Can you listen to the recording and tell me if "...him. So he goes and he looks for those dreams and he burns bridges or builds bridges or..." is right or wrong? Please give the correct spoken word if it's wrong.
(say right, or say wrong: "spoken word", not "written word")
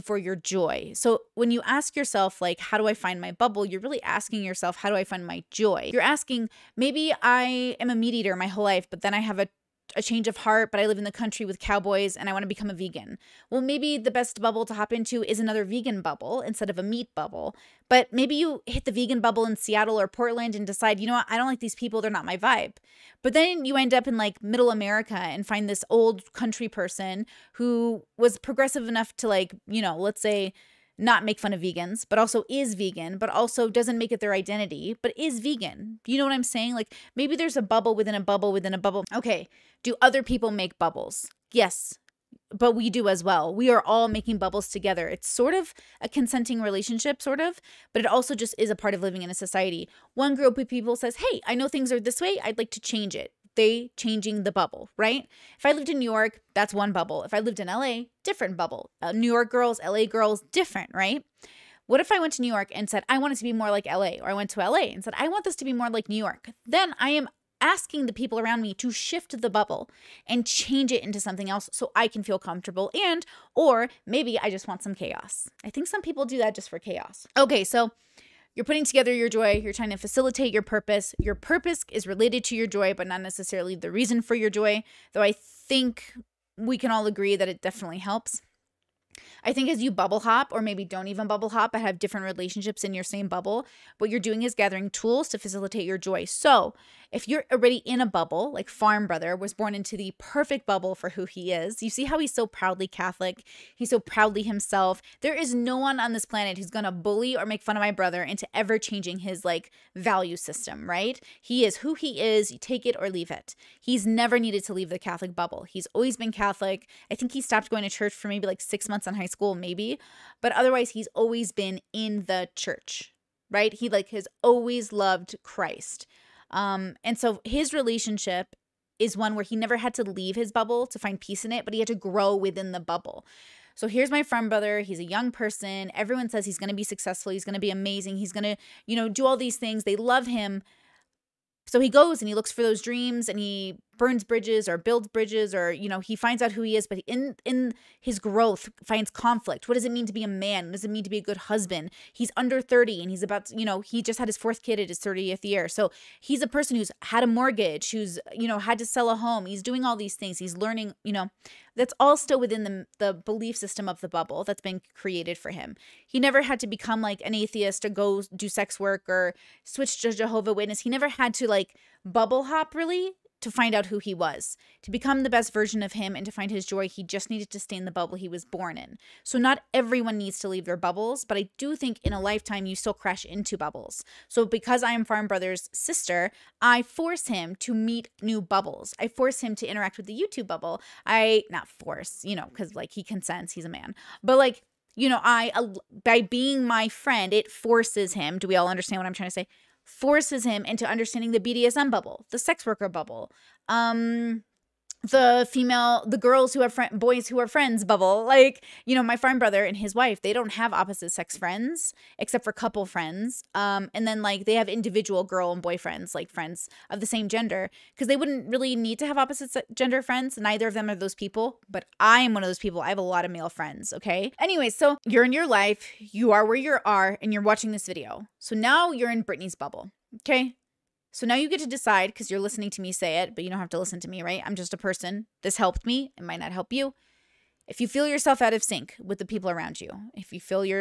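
right.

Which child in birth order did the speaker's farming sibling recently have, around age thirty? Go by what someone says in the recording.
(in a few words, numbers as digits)
4th.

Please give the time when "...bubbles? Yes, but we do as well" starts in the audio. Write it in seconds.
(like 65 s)
40 s.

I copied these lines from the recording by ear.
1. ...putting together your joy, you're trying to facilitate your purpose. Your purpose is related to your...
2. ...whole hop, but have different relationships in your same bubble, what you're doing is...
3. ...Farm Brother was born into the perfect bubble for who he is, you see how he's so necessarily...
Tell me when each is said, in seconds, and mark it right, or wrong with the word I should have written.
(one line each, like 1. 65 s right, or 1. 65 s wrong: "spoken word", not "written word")
1. 78 s right
2. 91 s wrong: "bubble", not "whole"
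3. 98 s wrong: "proudly", not "necessarily".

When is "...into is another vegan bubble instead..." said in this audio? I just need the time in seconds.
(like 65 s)
14 s.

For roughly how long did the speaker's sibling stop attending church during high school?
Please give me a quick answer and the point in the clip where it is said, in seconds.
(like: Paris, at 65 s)
6 months, at 118 s.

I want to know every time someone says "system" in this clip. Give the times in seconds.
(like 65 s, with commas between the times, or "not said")
110 s, 163 s.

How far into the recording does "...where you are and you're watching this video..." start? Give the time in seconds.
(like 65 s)
226 s.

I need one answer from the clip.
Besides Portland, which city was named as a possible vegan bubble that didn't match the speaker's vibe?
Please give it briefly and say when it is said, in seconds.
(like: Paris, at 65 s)
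Seattle, at 19 s.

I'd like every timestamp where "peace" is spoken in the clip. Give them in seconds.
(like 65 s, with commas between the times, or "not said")
131 s.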